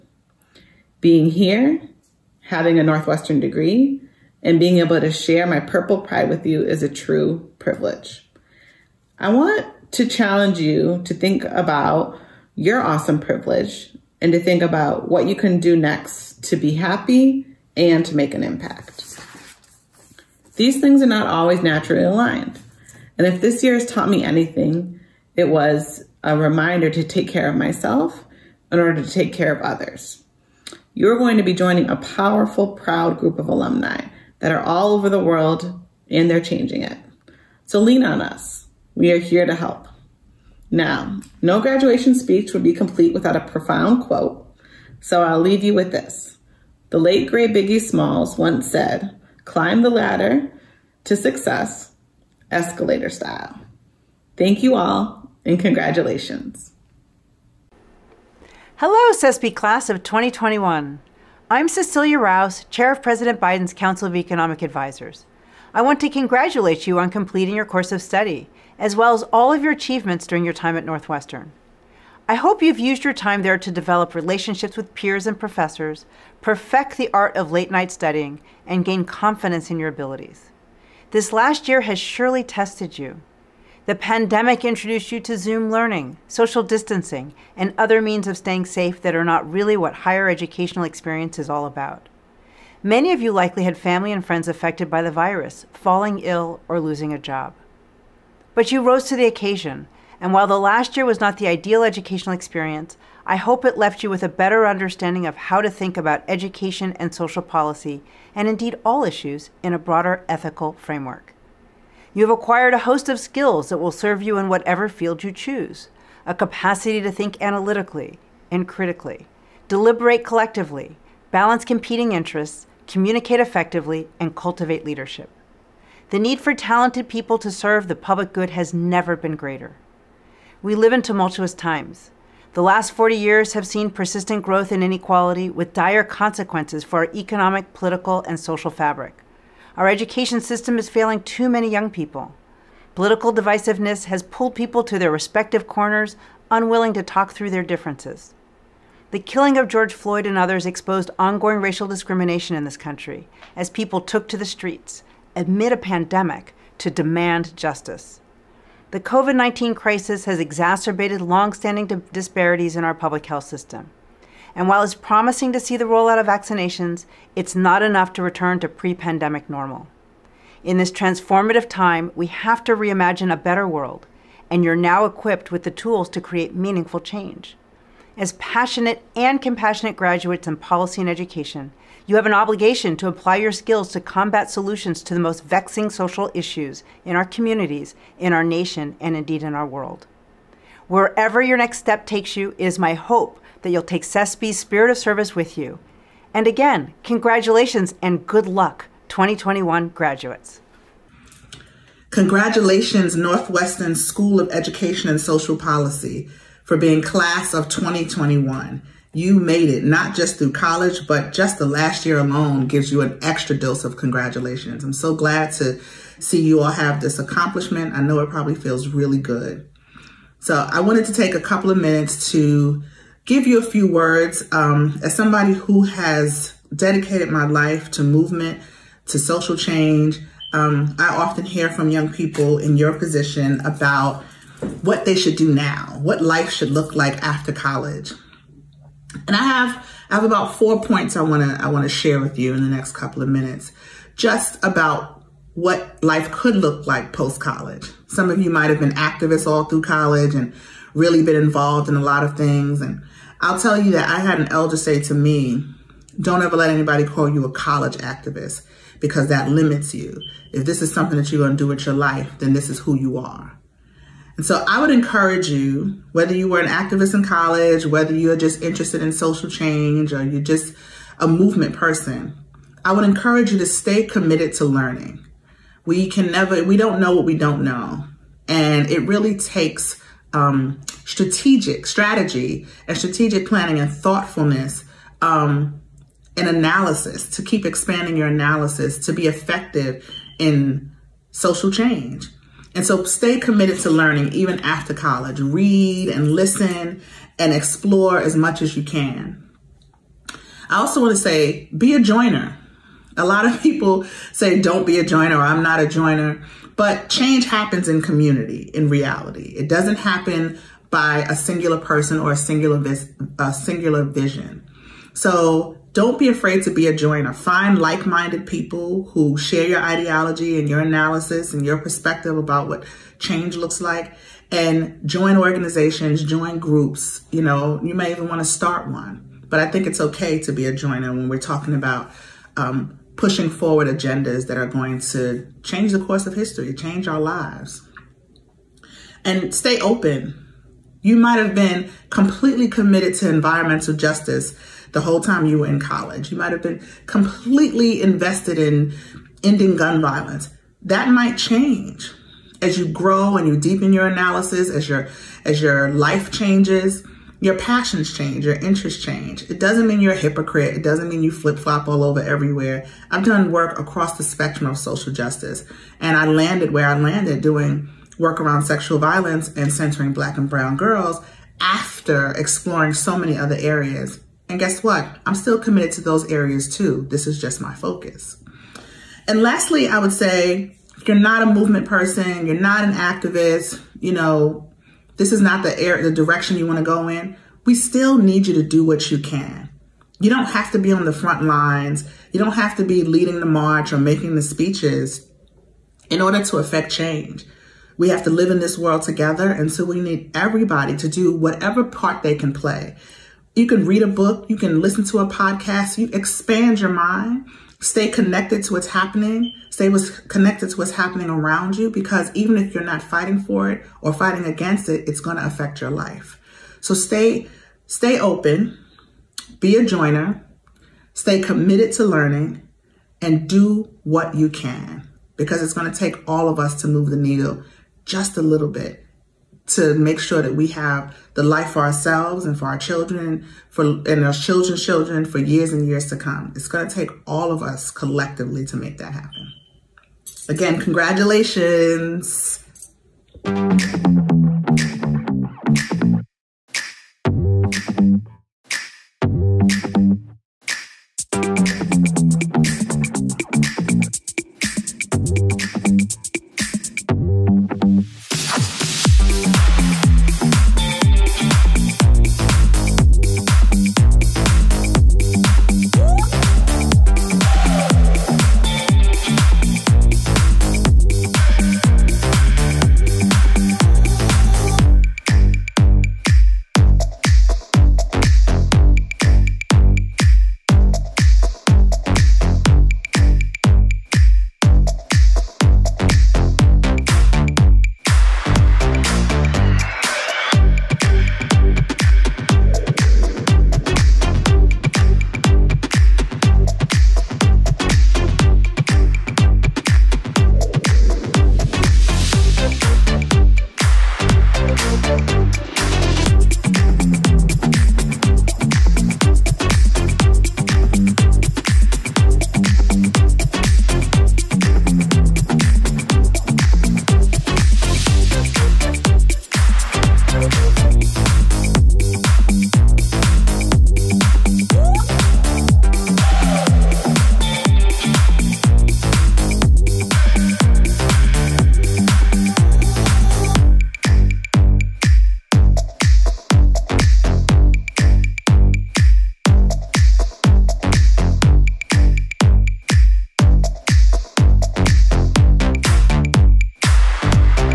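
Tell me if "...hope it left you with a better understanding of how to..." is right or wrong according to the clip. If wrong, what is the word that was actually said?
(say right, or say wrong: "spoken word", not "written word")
right.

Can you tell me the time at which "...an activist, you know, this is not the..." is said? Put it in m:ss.
6:22.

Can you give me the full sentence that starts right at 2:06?
The need for talented people to serve the public good has never been greater.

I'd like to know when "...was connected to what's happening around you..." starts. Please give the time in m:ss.
6:49.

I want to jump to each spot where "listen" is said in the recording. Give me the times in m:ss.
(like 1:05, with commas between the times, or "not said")
4:56, 6:44.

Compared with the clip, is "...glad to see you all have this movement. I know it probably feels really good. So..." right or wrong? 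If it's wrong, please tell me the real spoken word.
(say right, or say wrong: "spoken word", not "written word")
wrong: "accomplishment", not "movement".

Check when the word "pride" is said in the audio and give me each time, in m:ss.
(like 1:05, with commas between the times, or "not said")
0:06.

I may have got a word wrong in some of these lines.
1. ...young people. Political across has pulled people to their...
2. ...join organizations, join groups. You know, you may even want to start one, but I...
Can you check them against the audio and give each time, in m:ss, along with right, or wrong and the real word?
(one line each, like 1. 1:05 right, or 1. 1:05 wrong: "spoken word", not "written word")
1. 2:21 wrong: "divisiveness", not "across"
2. 5:25 right.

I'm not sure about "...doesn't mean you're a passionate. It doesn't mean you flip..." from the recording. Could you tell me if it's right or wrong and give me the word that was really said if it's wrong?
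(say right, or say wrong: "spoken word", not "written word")
wrong: "hypocrite", not "passionate".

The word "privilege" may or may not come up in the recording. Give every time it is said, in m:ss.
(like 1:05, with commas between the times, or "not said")
0:07, 0:13.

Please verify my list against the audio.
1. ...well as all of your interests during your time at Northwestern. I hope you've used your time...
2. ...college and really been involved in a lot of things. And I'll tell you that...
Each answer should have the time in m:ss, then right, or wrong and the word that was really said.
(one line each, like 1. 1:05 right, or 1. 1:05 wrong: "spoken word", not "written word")
1. 1:08 wrong: "achievements", not "interests"
2. 4:09 right.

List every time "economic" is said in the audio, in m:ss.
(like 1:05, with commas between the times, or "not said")
1:04, 2:17.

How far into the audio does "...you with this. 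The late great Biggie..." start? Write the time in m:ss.
0:45.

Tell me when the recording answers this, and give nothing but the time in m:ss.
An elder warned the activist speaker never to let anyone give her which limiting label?
4:17.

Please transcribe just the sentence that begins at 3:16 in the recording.
And again, congratulations and good luck, 2021 graduates.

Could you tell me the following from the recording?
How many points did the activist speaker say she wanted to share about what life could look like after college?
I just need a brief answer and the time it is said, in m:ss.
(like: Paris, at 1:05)
4, at 4:00.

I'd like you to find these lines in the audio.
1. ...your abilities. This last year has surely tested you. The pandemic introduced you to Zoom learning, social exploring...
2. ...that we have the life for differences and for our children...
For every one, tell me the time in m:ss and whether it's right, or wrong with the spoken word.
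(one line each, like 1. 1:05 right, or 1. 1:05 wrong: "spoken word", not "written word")
1. 1:19 wrong: "distancing", not "exploring"
2. 7:10 wrong: "ourselves", not "differences".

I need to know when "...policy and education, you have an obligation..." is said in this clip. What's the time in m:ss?
3:00.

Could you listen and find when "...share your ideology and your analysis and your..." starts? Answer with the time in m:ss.
5:19.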